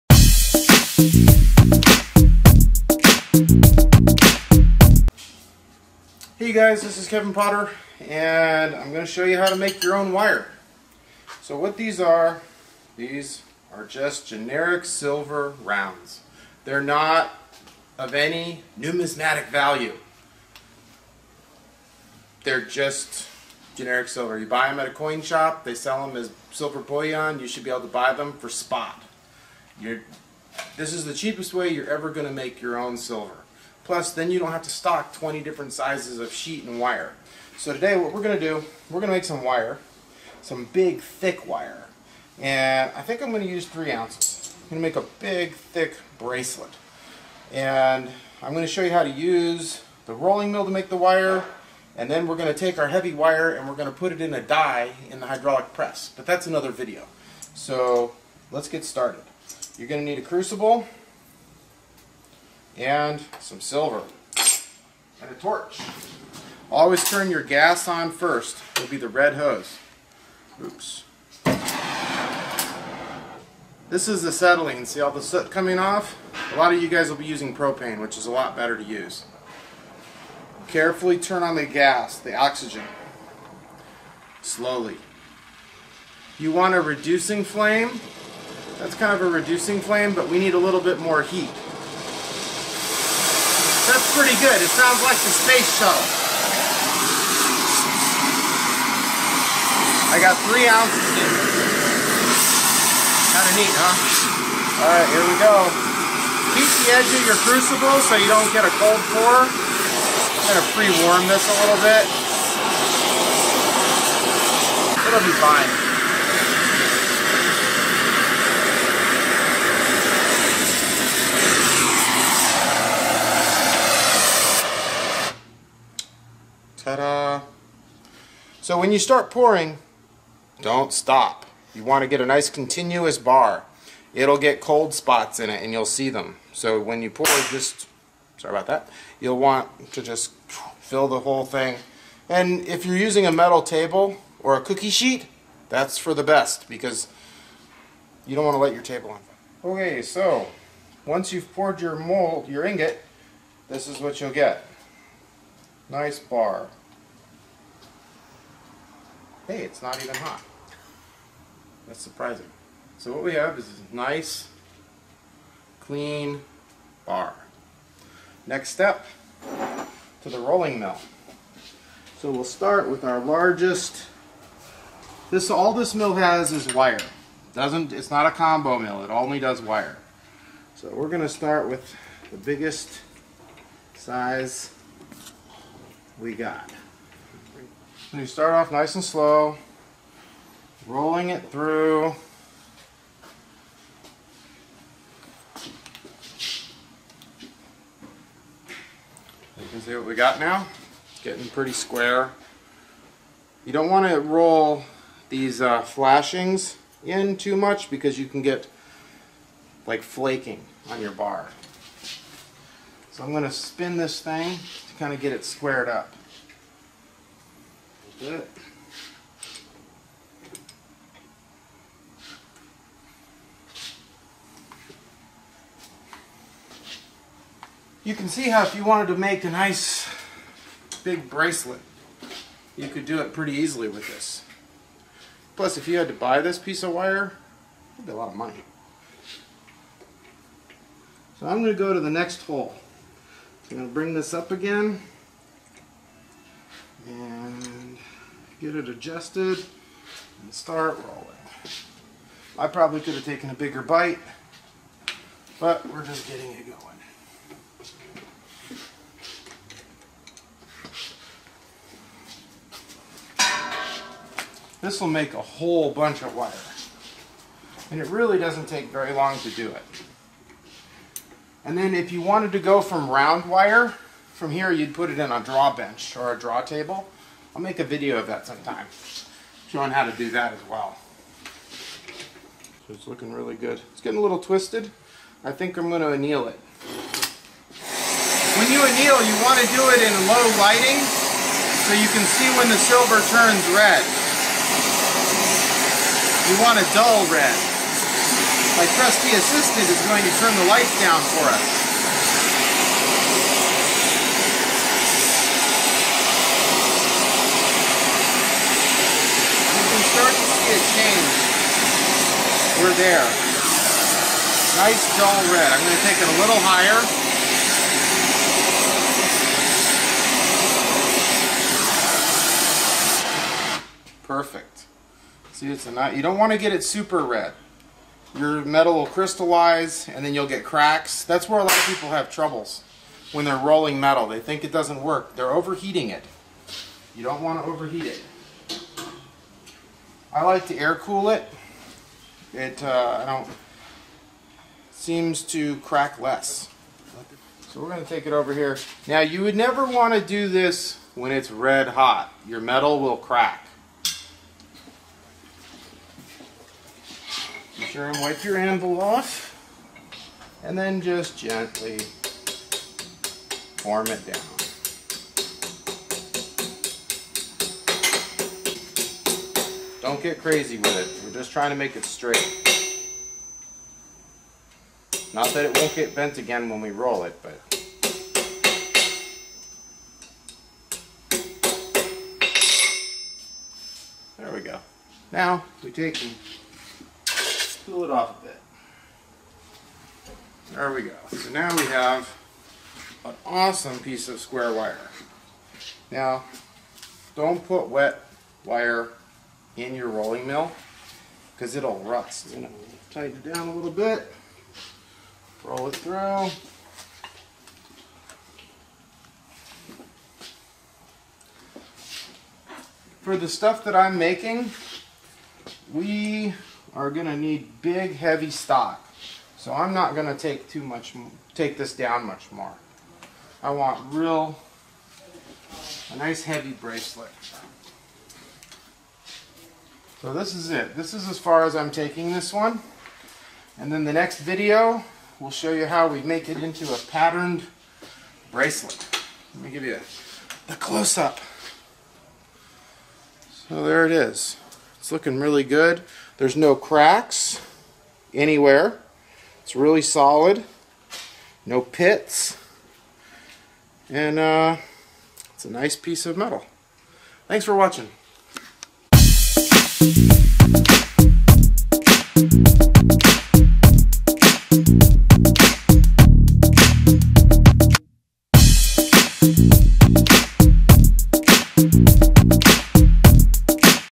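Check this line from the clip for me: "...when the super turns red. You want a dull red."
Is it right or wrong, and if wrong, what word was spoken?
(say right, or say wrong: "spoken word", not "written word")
wrong: "silver", not "super".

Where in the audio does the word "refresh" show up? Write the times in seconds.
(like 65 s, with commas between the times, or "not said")
not said.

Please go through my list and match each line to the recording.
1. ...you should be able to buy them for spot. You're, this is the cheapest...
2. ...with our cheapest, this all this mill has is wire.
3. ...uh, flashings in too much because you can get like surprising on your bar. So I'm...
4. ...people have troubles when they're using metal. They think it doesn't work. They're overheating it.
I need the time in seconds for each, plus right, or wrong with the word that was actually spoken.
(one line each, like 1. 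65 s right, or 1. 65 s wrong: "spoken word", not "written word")
1. 27 s right
2. 172 s wrong: "largest", not "cheapest"
3. 205 s wrong: "flaking", not "surprising"
4. 331 s wrong: "rolling", not "using".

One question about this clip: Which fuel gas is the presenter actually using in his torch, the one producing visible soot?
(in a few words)
Acetylene.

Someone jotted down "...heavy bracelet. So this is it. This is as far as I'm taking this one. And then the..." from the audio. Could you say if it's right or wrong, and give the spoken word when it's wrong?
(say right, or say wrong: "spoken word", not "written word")
right.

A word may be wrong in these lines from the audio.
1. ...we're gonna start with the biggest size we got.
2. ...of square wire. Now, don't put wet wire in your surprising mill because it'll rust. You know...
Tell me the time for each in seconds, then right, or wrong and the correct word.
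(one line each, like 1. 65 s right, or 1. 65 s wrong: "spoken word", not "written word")
1. 180 s right
2. 394 s wrong: "rolling", not "surprising".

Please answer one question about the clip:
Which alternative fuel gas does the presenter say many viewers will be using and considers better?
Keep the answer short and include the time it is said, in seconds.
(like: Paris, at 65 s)
Propane, at 77 s.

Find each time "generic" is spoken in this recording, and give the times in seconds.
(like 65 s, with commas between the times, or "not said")
14 s, 23 s.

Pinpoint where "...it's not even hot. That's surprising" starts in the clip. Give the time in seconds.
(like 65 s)
159 s.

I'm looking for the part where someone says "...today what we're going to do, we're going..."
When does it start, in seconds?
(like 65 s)
37 s.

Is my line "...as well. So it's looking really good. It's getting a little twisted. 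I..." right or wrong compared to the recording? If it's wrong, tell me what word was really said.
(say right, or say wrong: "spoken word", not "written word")
right.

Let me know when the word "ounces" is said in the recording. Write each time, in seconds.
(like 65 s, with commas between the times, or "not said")
43 s, 100 s.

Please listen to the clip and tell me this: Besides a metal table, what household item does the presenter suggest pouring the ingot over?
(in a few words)
A cookie sheet.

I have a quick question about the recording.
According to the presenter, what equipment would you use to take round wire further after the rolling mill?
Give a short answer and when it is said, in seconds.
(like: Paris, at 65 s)
A draw bench, at 275 s.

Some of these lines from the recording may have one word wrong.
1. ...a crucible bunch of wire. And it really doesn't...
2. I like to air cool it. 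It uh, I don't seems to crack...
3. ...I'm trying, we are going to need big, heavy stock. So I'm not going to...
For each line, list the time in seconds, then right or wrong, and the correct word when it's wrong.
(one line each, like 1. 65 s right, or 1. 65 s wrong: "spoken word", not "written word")
1. 265 s wrong: "whole", not "crucible"
2. 340 s right
3. 413 s wrong: "making", not "trying".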